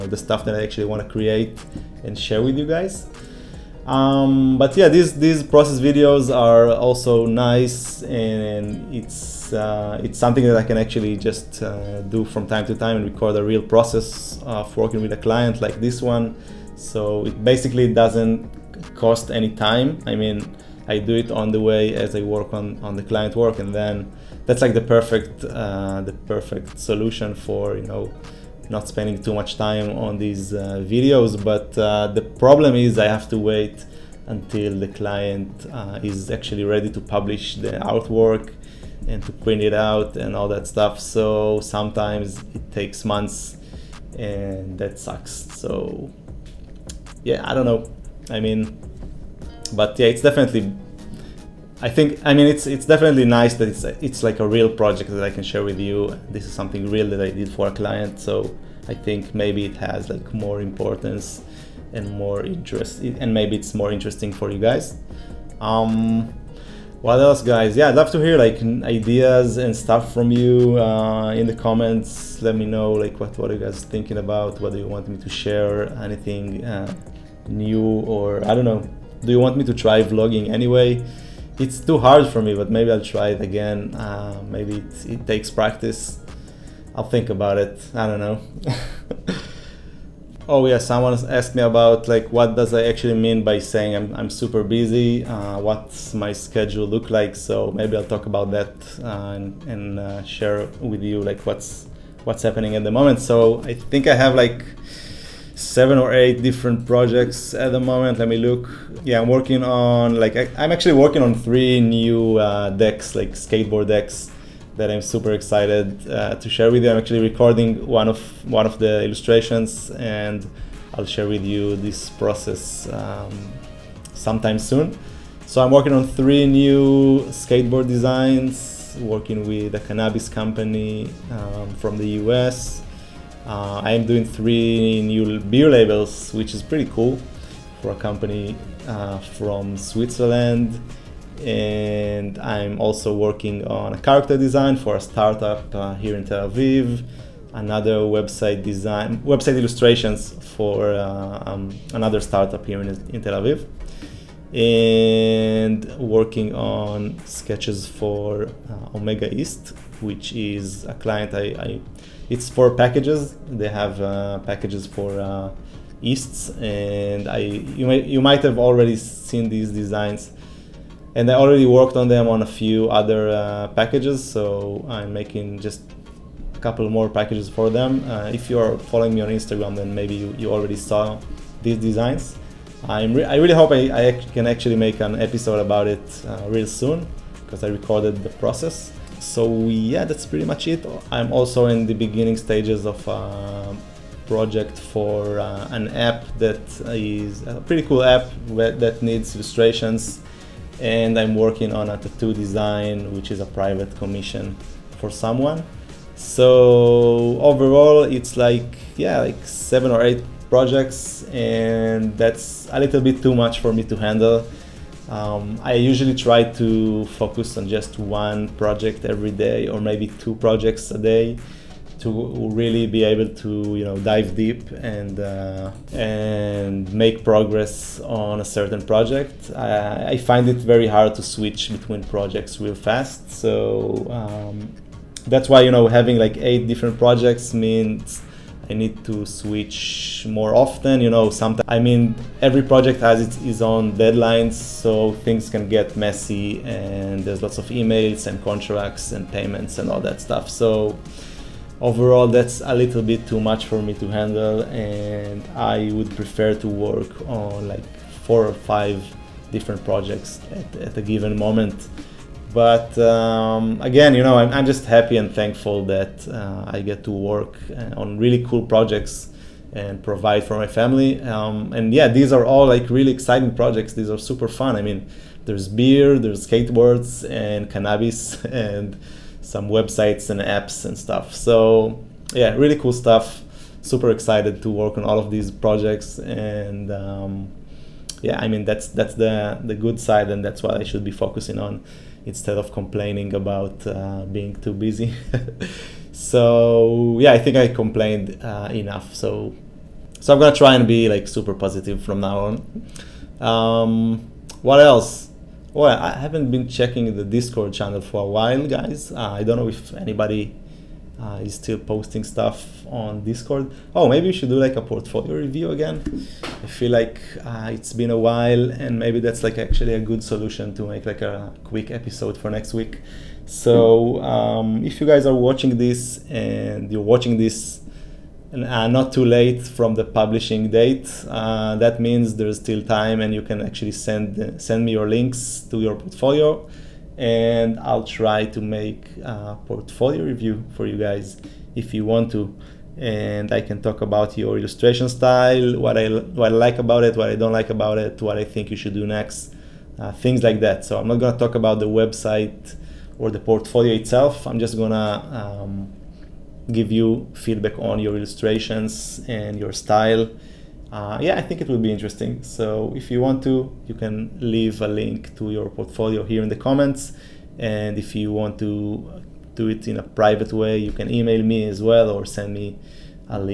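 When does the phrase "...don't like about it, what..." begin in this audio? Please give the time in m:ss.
5:47.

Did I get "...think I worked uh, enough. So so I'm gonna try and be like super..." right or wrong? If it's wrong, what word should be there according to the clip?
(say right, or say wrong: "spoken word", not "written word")
wrong: "complained", not "worked".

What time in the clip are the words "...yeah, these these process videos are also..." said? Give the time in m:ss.
0:04.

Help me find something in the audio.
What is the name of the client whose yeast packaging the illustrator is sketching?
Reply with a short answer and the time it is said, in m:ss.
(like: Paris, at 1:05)
Omega Yeast, at 2:38.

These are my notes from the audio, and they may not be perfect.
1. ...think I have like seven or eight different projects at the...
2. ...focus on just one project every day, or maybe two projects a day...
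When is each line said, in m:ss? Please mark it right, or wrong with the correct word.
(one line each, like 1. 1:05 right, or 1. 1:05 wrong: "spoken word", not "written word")
1. 1:43 right
2. 3:37 right.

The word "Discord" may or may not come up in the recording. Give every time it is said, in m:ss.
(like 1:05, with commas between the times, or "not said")
5:07, 5:13.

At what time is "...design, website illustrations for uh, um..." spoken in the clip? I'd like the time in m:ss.
2:28.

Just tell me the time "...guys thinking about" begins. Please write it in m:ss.
1:13.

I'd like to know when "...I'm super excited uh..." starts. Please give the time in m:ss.
1:54.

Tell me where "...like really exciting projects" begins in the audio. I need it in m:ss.
4:32.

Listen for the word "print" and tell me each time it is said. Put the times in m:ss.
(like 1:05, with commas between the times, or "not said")
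0:39.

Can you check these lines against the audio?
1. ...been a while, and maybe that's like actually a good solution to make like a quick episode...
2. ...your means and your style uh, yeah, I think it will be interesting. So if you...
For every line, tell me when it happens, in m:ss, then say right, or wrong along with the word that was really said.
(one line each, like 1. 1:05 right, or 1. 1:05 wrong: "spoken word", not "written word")
1. 5:17 right
2. 5:57 wrong: "illustrations", not "means".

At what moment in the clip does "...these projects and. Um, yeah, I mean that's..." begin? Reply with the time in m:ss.
4:45.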